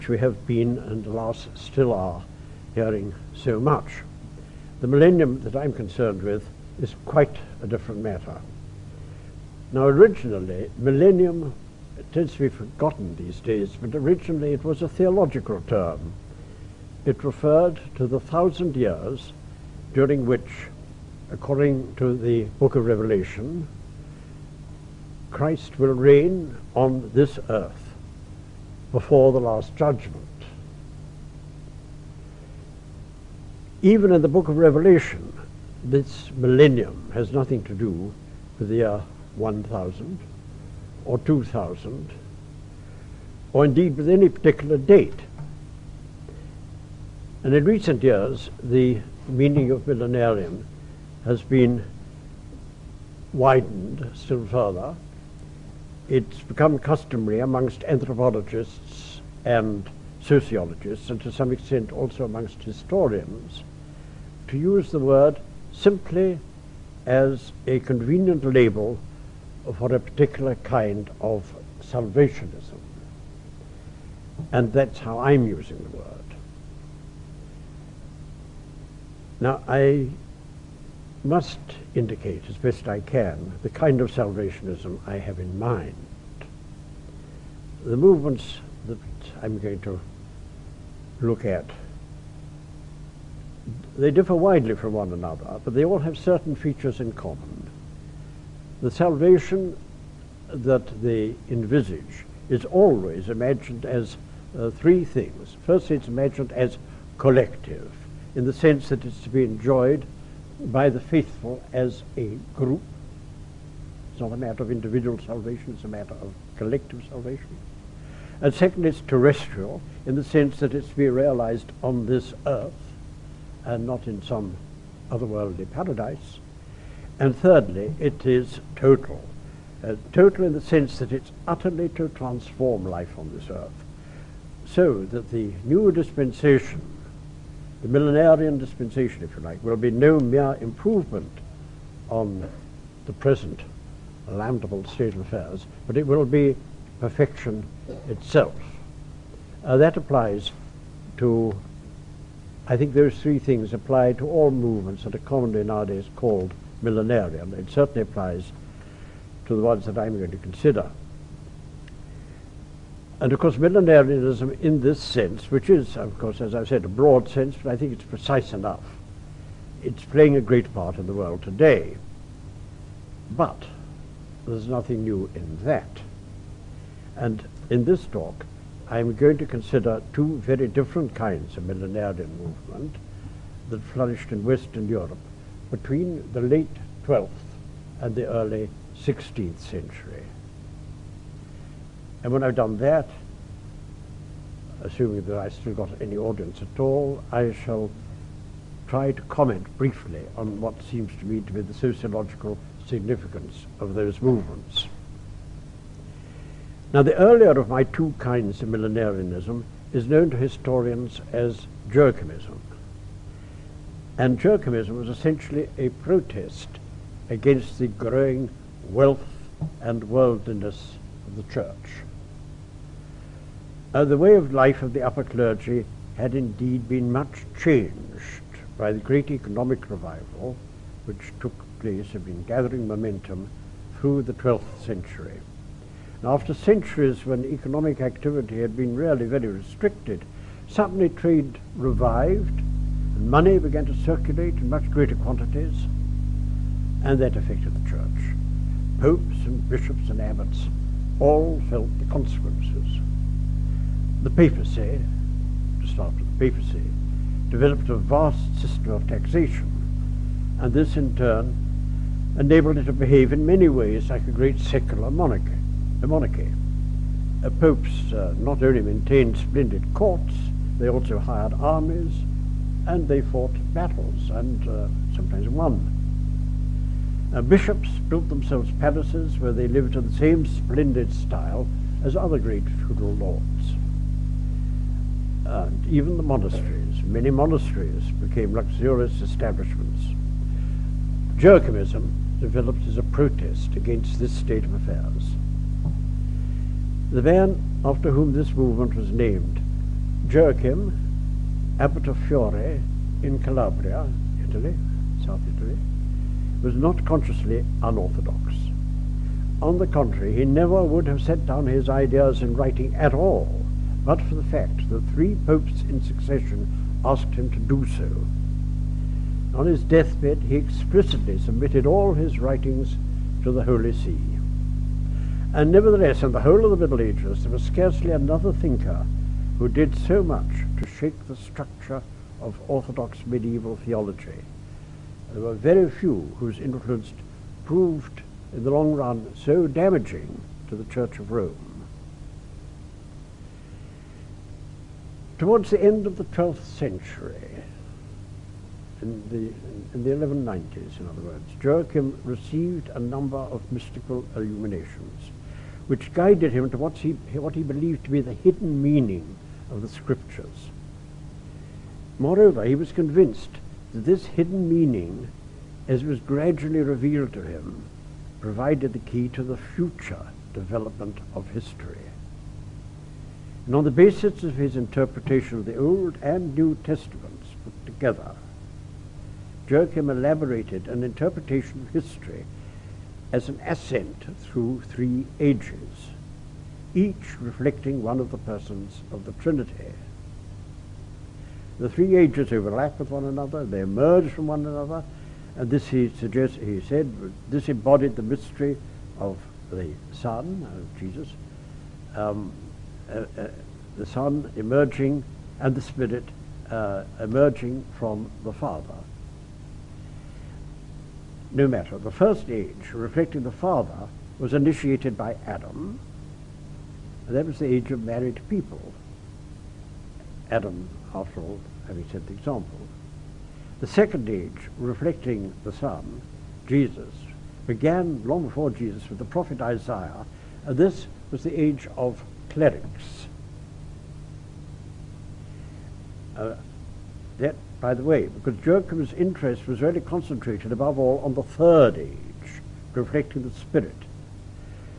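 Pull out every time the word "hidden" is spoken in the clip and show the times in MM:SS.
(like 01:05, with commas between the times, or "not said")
05:58, 06:04.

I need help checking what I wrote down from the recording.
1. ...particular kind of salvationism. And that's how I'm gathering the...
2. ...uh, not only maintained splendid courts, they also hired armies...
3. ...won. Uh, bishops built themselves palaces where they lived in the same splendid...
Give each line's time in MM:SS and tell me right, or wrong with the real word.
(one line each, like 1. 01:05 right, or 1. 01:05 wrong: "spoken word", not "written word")
1. 01:09 wrong: "using", not "gathering"
2. 04:28 right
3. 04:35 right.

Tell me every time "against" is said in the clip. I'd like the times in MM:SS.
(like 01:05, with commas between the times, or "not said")
03:37, 04:53.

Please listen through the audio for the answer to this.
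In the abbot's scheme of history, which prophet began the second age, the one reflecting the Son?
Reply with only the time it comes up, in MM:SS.
07:09.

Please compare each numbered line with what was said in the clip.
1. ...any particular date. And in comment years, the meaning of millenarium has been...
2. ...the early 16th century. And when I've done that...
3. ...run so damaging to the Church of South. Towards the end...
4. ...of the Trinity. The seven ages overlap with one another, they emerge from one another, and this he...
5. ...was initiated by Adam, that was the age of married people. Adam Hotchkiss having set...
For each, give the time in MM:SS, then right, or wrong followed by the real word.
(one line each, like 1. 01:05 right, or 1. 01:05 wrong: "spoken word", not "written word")
1. 00:44 wrong: "recent", not "comment"
2. 03:08 right
3. 05:38 wrong: "Rome", not "South"
4. 06:29 wrong: "three", not "seven"
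5. 06:54 right.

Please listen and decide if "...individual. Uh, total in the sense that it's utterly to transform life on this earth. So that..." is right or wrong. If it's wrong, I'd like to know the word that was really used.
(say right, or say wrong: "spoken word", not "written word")
wrong: "total", not "individual".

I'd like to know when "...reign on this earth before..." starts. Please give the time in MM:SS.
00:25.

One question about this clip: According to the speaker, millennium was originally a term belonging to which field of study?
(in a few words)
theological.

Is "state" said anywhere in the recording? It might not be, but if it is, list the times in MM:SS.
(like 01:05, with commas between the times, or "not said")
02:24, 04:54.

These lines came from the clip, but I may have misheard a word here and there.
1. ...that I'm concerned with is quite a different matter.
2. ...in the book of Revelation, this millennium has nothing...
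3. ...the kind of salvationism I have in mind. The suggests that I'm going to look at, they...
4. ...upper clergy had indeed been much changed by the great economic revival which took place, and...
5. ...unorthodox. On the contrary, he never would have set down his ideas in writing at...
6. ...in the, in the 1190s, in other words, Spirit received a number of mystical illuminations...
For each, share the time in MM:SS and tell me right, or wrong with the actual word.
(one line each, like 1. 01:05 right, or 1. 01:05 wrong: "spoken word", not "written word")
1. 00:05 right
2. 00:34 right
3. 01:23 wrong: "movements", not "suggests"
4. 03:45 right
5. 05:07 right
6. 05:48 wrong: "Joachim", not "Spirit".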